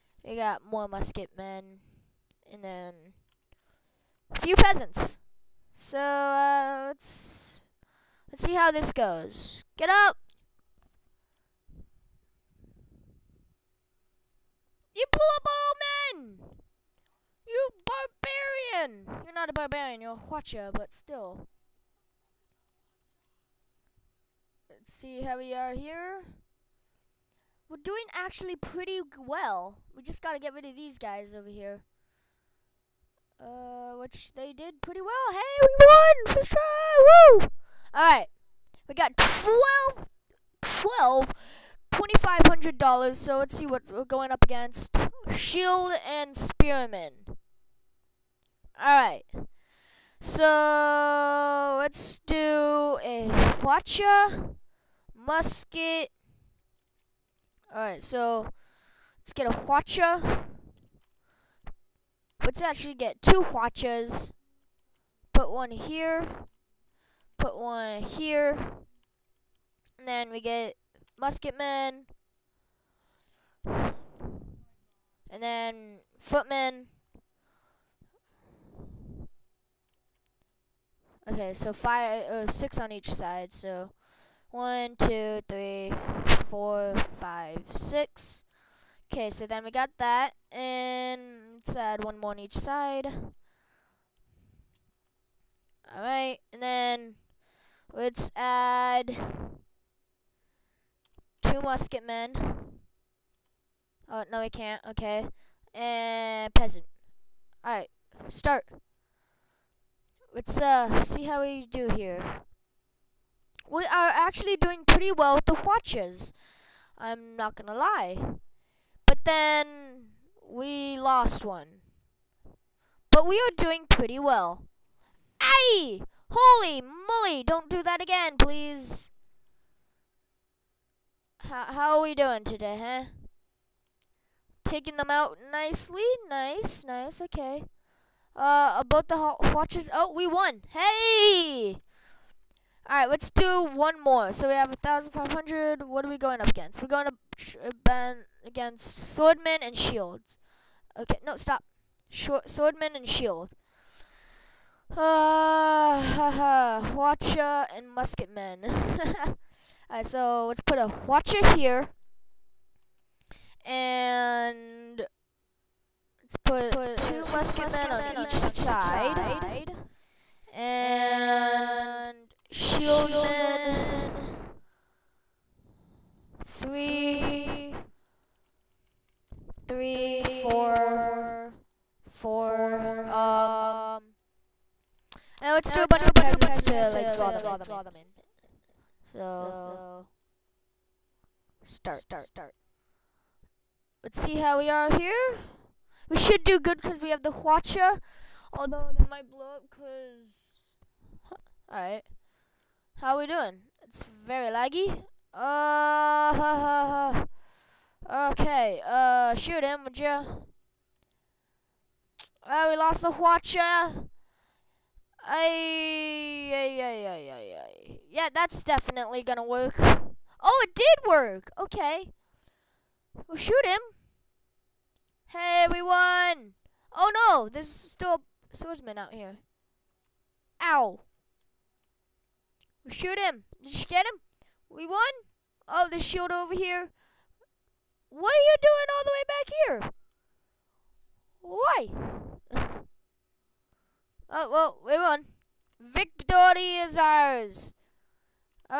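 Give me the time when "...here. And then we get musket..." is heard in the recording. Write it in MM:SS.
01:08.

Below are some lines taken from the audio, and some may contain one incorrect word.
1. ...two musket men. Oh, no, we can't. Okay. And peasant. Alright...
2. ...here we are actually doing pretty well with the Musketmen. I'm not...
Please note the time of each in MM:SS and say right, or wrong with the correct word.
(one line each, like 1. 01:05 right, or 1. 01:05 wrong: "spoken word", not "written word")
1. 01:41 right
2. 01:51 wrong: "Hwachas", not "Musketmen".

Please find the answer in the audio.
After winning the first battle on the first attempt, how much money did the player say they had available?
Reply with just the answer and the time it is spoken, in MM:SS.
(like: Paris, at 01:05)
$2,500, at 00:41.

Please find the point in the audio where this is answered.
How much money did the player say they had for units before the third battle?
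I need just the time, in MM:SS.
02:24.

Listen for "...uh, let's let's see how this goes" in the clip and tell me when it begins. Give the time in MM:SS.
00:05.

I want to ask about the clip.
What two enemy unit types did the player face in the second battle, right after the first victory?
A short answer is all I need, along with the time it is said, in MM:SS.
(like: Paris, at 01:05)
Shield and Spearman, at 00:45.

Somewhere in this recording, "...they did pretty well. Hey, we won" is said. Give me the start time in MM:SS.
00:34.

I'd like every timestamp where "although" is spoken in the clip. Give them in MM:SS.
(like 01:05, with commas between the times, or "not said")
03:18.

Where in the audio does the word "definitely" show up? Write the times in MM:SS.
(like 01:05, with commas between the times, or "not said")
03:38.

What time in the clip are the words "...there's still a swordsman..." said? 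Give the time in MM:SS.
03:47.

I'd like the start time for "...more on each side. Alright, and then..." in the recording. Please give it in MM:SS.
01:32.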